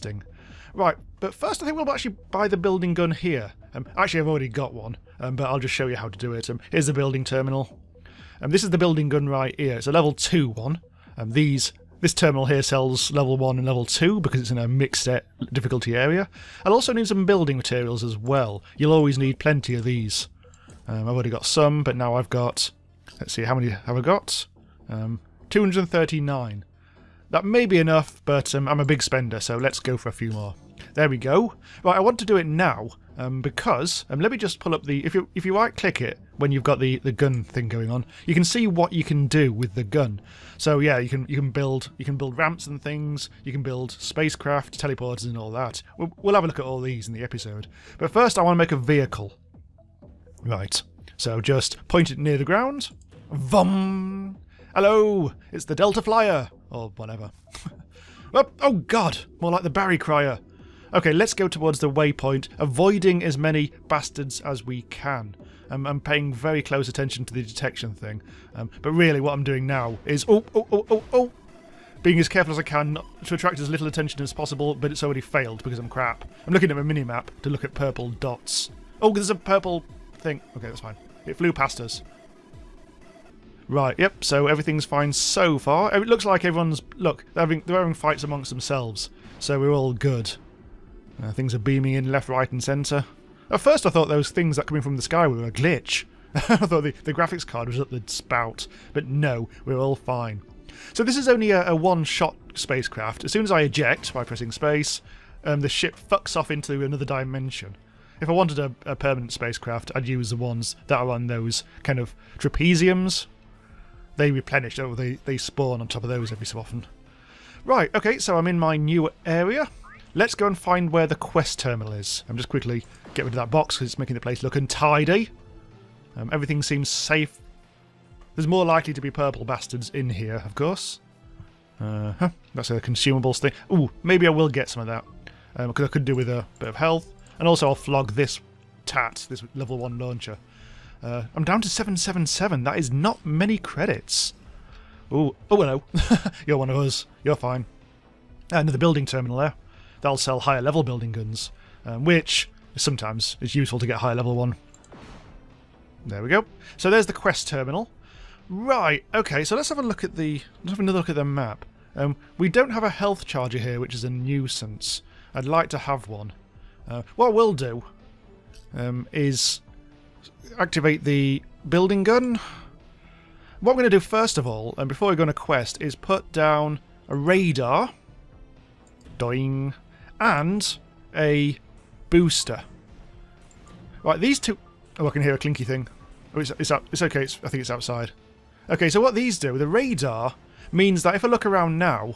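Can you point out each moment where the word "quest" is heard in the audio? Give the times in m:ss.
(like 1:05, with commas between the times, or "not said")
2:01, 2:37, 2:55.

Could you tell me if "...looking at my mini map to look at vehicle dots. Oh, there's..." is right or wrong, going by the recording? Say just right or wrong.
wrong.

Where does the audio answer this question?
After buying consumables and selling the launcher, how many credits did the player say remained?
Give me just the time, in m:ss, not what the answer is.
2:21.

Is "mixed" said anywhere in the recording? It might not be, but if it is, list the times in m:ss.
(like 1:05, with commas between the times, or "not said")
0:14.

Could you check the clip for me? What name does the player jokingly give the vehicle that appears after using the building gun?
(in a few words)
Delta Flyer.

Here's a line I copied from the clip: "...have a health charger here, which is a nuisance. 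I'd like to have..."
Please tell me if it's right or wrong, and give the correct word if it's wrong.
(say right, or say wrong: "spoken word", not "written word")
right.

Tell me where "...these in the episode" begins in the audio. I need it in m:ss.
0:46.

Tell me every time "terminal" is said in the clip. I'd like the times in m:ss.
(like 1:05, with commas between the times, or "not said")
0:07, 0:12, 2:01, 2:29, 2:37.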